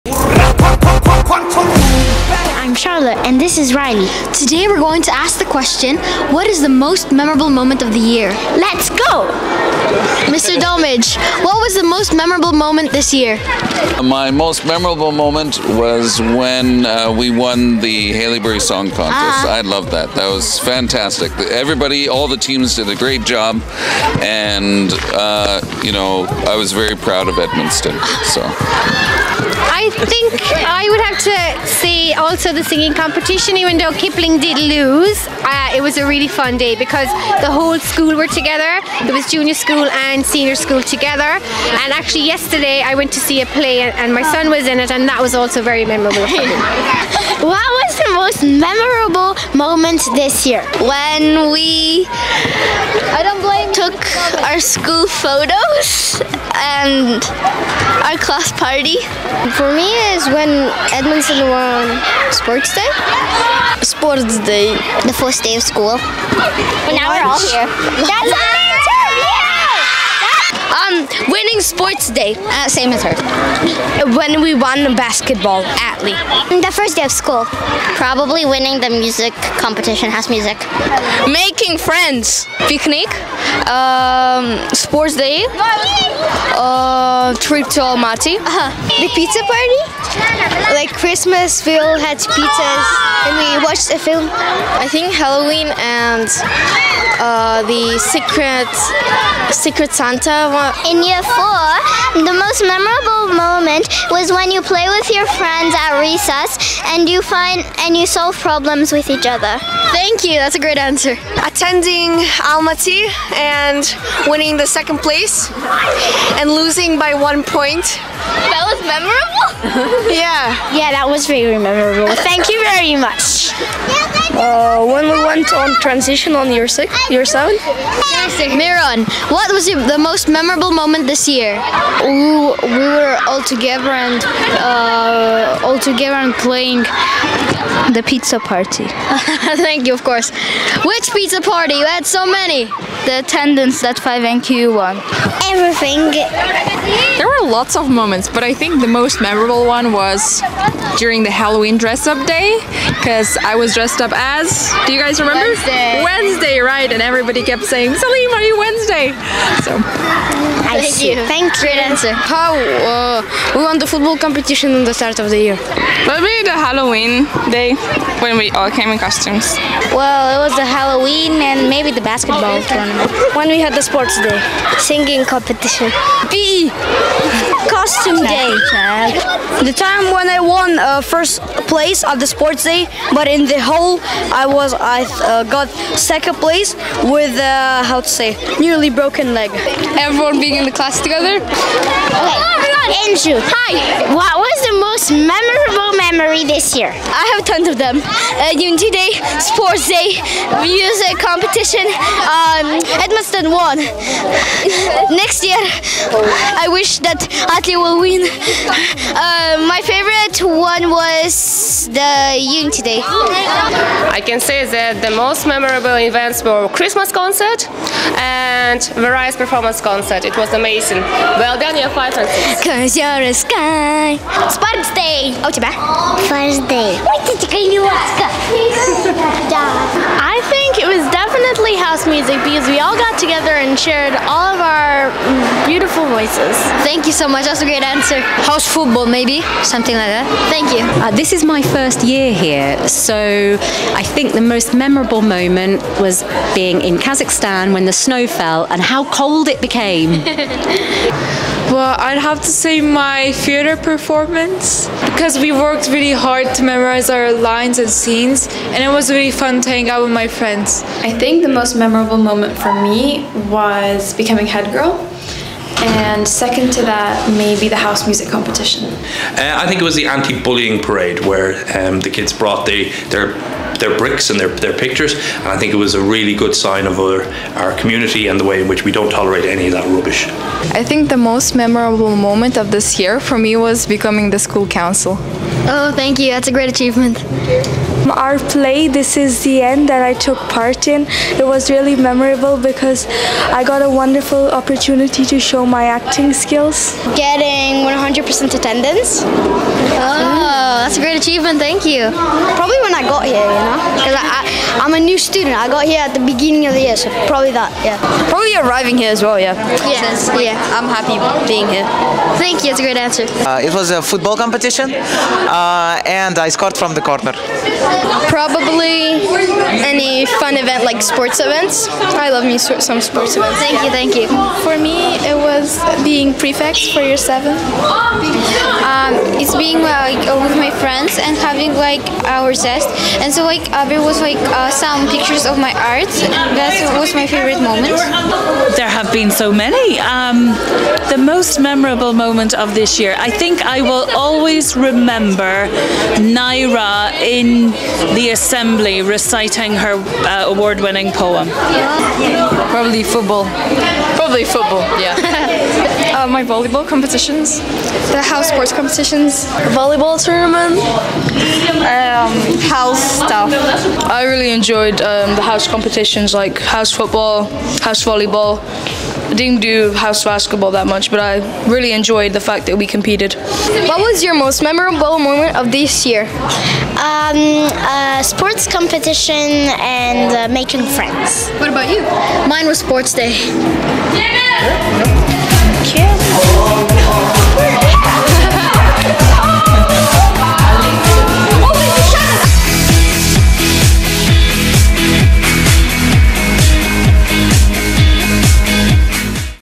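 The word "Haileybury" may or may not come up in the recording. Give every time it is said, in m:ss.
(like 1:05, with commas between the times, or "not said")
0:18.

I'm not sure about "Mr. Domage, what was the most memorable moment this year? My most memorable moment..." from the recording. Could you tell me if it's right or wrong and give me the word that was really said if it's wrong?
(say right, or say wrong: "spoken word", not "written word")
right.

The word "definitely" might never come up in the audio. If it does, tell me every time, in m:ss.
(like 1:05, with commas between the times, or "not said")
3:51.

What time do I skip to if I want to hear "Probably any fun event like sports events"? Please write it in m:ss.
5:18.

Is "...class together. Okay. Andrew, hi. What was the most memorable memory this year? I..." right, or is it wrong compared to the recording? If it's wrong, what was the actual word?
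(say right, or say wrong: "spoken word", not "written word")
right.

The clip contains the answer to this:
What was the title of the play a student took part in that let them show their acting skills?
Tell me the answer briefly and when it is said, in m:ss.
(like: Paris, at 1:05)
This Is the End, at 4:48.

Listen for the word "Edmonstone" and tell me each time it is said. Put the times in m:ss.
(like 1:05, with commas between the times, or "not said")
0:27, 1:00, 3:23.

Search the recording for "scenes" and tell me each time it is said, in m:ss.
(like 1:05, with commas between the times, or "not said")
4:17.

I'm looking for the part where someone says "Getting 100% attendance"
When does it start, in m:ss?
4:57.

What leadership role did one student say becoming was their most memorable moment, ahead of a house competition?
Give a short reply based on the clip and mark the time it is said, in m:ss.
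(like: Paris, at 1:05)
Head girl, at 4:24.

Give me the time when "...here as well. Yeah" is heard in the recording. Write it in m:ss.
5:08.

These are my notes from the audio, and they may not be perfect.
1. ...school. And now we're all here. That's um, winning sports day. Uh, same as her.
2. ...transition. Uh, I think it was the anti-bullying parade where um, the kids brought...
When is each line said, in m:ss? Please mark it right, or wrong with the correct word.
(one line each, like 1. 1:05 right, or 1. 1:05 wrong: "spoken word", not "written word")
1. 1:05 right
2. 4:28 wrong: "competition", not "transition".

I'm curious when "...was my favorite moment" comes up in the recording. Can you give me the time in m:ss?
5:36.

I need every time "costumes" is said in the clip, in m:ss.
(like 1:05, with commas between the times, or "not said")
2:48, 2:57.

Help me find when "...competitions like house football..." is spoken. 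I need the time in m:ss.
6:05.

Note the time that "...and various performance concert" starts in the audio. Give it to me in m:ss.
3:38.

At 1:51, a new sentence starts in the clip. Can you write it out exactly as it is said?
Attending Almaty and winning the second place and losing by one point.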